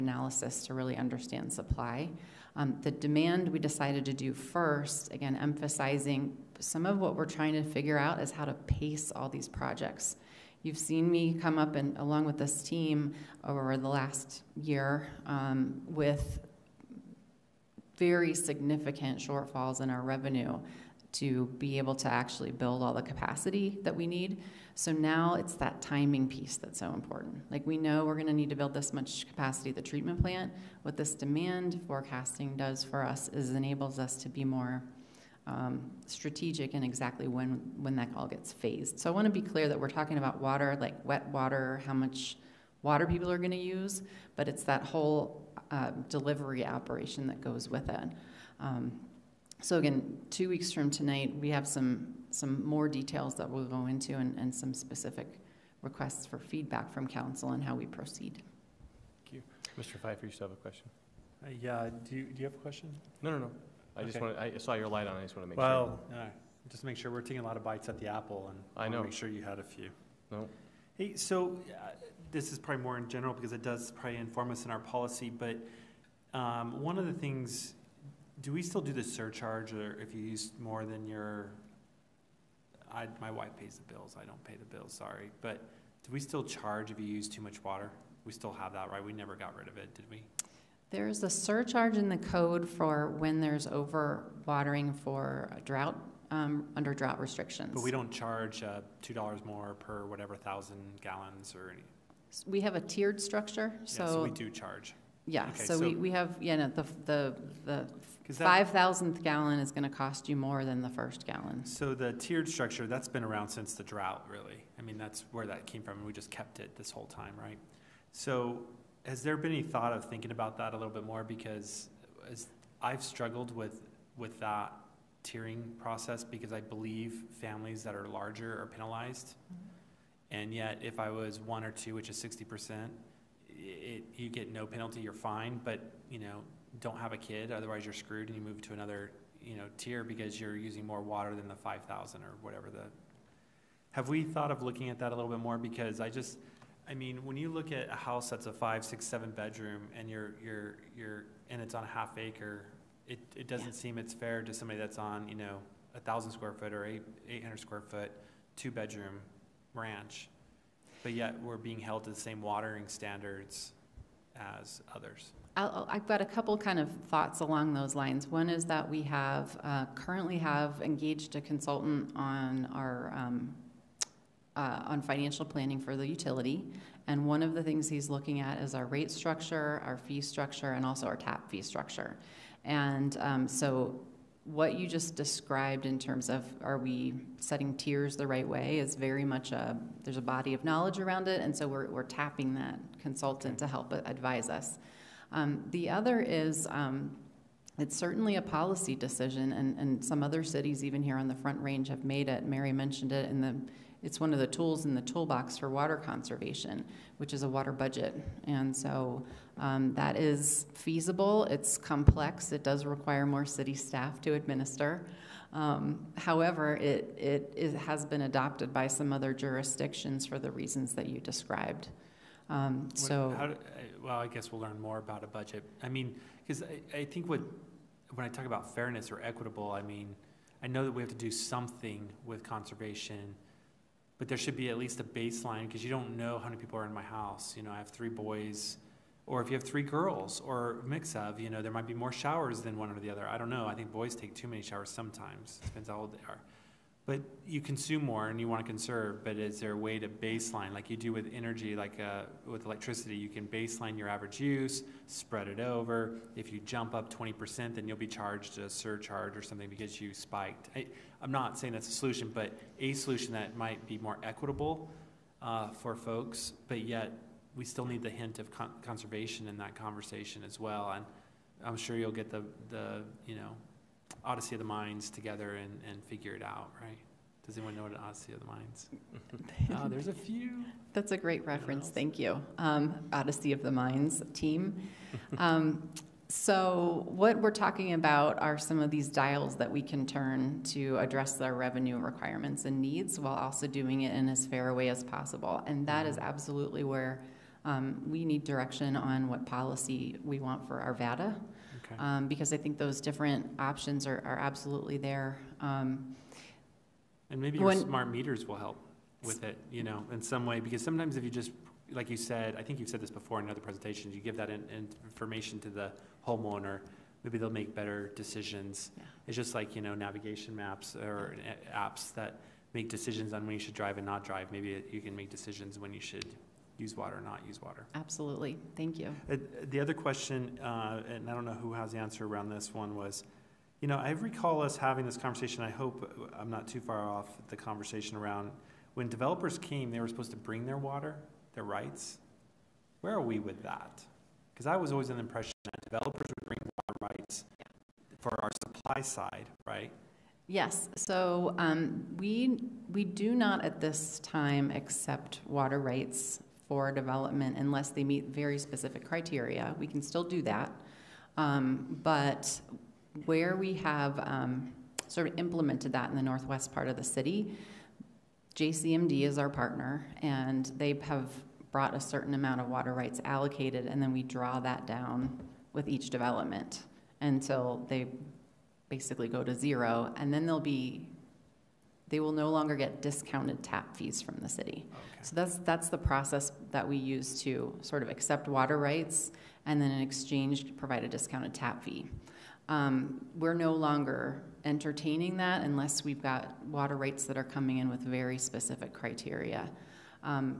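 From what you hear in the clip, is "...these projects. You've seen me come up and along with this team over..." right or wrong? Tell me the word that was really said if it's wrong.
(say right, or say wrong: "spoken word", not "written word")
right.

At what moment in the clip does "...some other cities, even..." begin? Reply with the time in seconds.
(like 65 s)
200 s.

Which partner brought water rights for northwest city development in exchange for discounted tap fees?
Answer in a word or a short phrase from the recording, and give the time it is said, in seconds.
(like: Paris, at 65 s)
JCMD, at 368 s.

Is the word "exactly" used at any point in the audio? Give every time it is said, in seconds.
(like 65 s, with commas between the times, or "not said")
36 s.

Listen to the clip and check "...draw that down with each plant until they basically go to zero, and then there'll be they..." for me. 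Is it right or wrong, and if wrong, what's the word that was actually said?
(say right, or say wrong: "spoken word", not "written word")
wrong: "development", not "plant".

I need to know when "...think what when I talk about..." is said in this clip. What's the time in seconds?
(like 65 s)
227 s.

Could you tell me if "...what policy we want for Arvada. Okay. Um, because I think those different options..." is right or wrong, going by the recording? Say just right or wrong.
right.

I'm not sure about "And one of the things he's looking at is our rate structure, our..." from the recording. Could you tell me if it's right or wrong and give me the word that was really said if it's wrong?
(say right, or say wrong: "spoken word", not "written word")
right.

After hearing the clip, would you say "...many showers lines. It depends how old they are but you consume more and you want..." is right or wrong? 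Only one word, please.
wrong.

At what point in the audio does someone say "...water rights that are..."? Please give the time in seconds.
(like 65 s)
396 s.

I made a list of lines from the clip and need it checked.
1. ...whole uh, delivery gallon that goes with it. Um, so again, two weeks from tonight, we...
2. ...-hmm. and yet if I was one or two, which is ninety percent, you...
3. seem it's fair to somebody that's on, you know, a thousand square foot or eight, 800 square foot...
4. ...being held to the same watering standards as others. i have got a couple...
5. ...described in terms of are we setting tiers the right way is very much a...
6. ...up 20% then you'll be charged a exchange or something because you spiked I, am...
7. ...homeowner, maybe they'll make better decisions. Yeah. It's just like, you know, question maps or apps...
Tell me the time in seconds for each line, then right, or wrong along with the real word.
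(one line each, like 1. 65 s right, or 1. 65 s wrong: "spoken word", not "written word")
1. 44 s wrong: "operation", not "gallon"
2. 129 s wrong: "sixty", not "ninety"
3. 153 s right
4. 161 s right
5. 185 s right
6. 256 s wrong: "surcharge", not "exchange"
7. 316 s wrong: "navigation", not "question".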